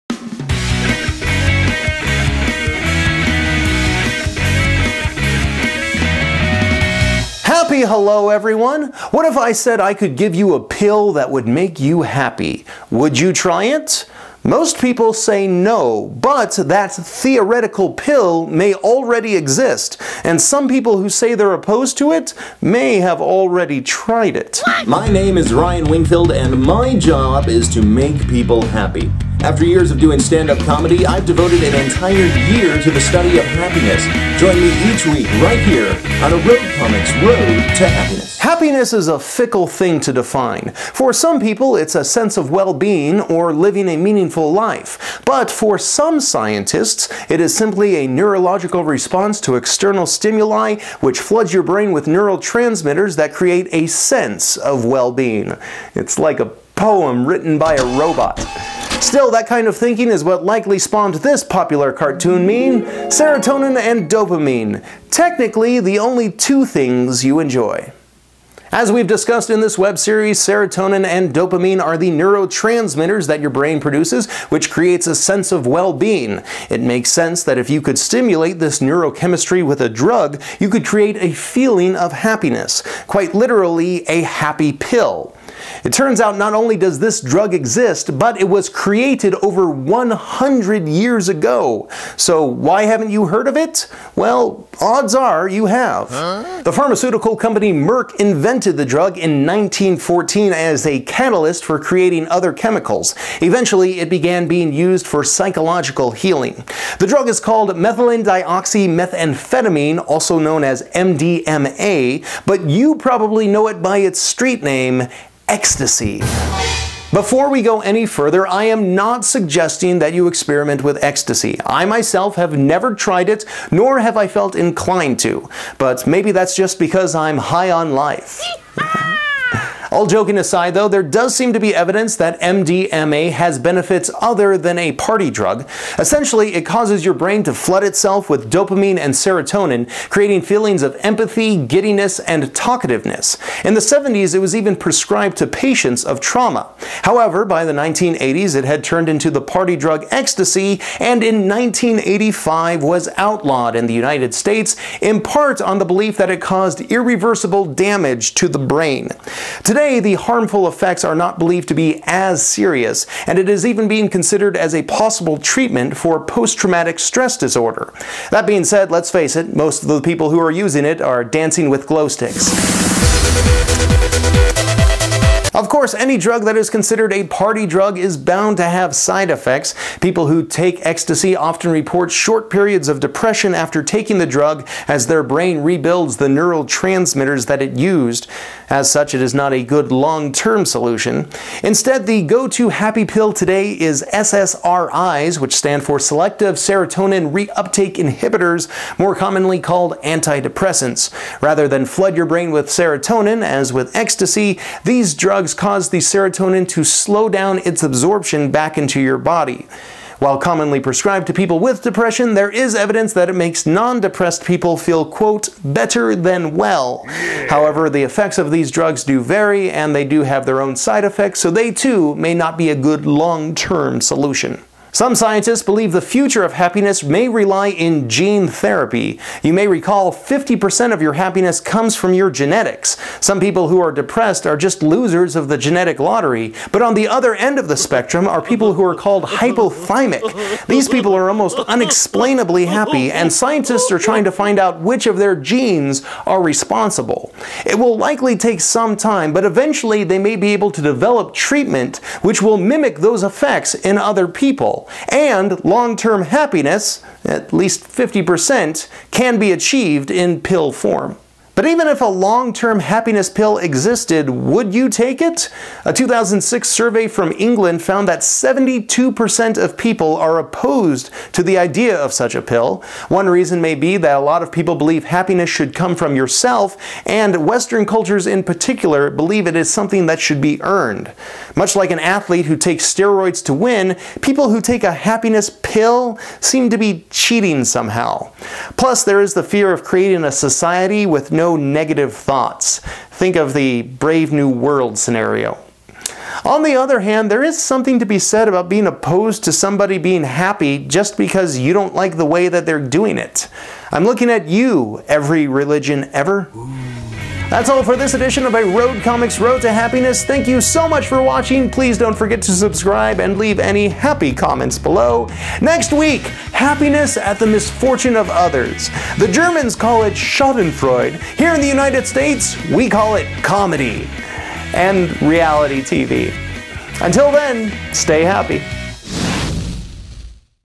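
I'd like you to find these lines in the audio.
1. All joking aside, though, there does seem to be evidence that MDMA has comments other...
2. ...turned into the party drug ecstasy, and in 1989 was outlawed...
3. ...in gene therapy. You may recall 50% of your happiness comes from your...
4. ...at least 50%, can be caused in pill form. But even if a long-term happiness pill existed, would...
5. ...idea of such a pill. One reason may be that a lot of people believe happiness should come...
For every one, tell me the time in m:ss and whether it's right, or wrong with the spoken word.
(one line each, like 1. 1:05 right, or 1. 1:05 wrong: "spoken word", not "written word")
1. 2:09 wrong: "benefits", not "comments"
2. 2:28 wrong: "1985", not "1989"
3. 3:47 right
4. 4:17 wrong: "achieved", not "caused"
5. 4:31 right.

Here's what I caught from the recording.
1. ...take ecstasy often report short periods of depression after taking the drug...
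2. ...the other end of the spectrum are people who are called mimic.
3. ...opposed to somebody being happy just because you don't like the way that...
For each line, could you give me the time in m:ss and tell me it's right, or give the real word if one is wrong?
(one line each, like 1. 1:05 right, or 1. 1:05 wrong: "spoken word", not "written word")
1. 3:00 right
2. 3:56 wrong: "hyperthymic", not "mimic"
3. 4:58 right.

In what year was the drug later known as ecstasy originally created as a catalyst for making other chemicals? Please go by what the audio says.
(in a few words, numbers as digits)
1914.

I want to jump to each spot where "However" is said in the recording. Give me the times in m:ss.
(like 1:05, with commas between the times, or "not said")
2:27, 3:37.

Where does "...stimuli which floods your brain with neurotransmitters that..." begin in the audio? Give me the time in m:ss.
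0:50.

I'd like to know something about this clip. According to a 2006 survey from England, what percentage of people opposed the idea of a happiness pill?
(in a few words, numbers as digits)
72%.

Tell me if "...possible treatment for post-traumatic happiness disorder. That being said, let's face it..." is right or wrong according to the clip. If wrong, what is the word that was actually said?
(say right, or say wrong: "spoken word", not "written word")
wrong: "stress", not "happiness".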